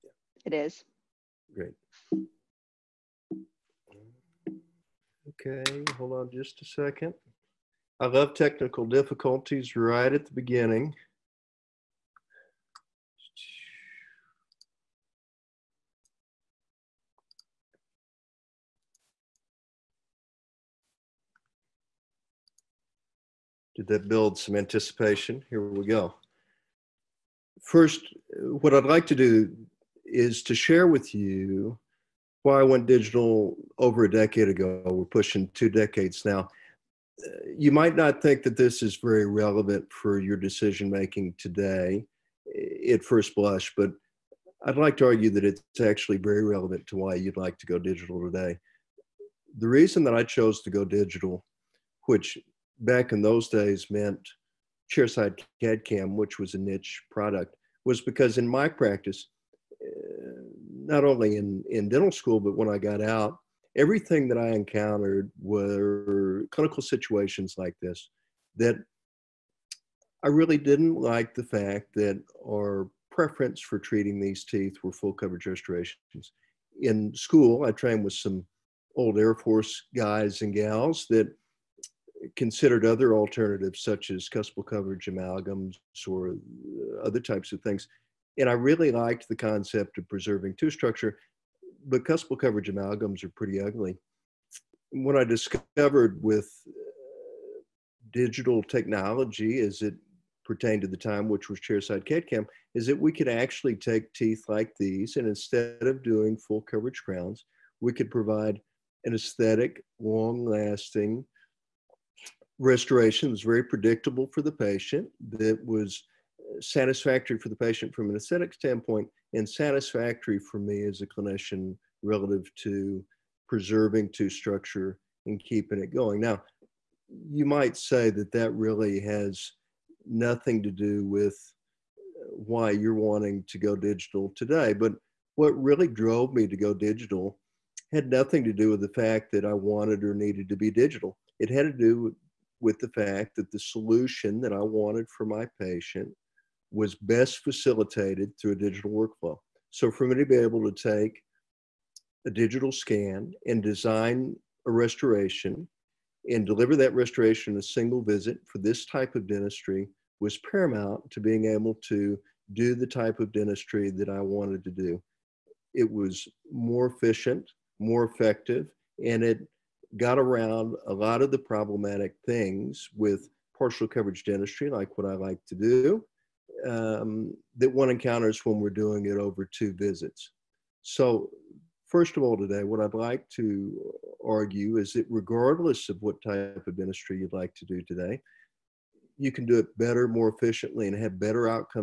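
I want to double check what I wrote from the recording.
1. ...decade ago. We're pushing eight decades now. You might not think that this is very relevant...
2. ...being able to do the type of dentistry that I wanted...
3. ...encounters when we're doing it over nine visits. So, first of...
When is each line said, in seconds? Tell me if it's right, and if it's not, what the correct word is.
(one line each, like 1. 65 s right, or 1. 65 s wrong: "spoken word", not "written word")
1. 34 s wrong: "two", not "eight"
2. 161 s right
3. 177 s wrong: "two", not "nine".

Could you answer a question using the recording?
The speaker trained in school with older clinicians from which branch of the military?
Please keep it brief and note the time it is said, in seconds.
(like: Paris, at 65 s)
Air Force, at 79 s.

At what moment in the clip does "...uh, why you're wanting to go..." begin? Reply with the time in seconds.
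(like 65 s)
132 s.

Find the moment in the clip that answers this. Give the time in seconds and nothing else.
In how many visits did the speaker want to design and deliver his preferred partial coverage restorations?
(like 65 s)
157 s.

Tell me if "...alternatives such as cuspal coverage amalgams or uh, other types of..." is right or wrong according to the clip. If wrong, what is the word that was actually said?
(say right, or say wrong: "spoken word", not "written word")
right.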